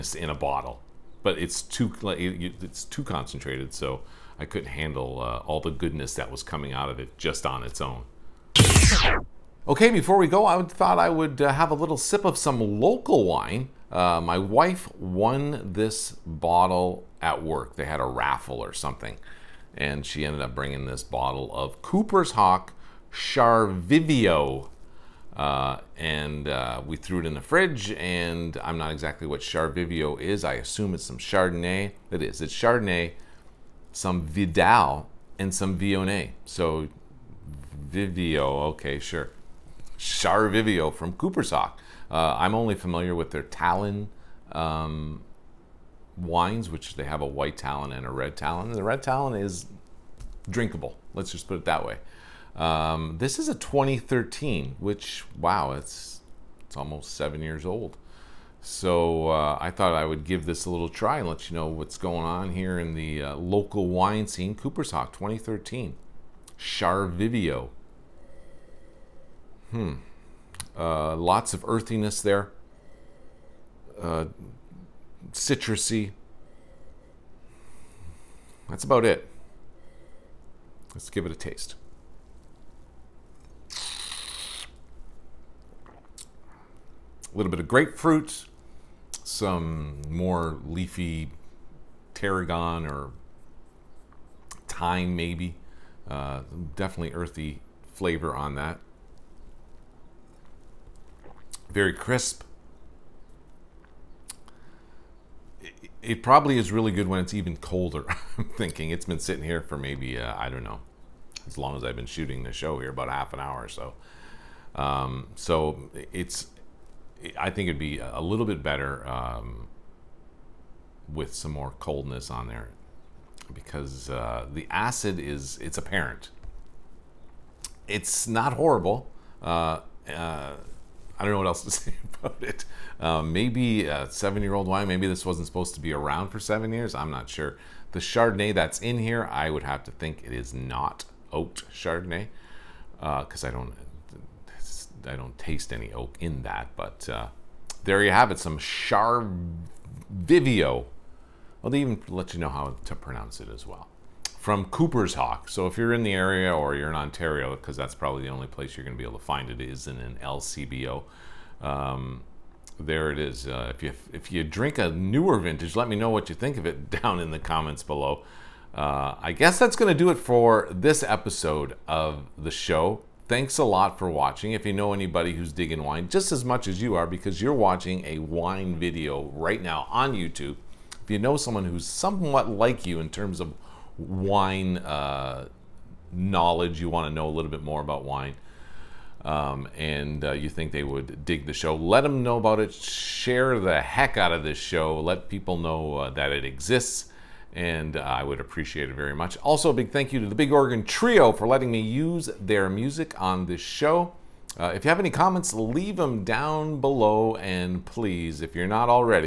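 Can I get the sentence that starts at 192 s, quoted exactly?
Share the heck out of this show.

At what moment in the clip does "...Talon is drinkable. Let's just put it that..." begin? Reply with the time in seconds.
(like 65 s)
49 s.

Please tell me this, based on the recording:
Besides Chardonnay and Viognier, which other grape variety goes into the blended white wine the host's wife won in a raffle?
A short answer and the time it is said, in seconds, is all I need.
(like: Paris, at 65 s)
Vidal, at 34 s.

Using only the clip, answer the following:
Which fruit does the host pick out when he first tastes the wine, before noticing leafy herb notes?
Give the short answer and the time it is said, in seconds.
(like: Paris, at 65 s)
Grapefruit, at 87 s.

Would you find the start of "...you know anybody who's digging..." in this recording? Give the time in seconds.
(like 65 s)
174 s.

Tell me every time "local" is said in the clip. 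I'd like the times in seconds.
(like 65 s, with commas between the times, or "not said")
12 s, 63 s.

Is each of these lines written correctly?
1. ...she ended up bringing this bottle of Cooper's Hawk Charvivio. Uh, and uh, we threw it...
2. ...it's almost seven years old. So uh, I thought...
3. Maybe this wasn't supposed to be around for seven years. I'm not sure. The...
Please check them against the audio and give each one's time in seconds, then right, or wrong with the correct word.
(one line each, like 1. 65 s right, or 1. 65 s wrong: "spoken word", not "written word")
1. 20 s right
2. 56 s right
3. 134 s right.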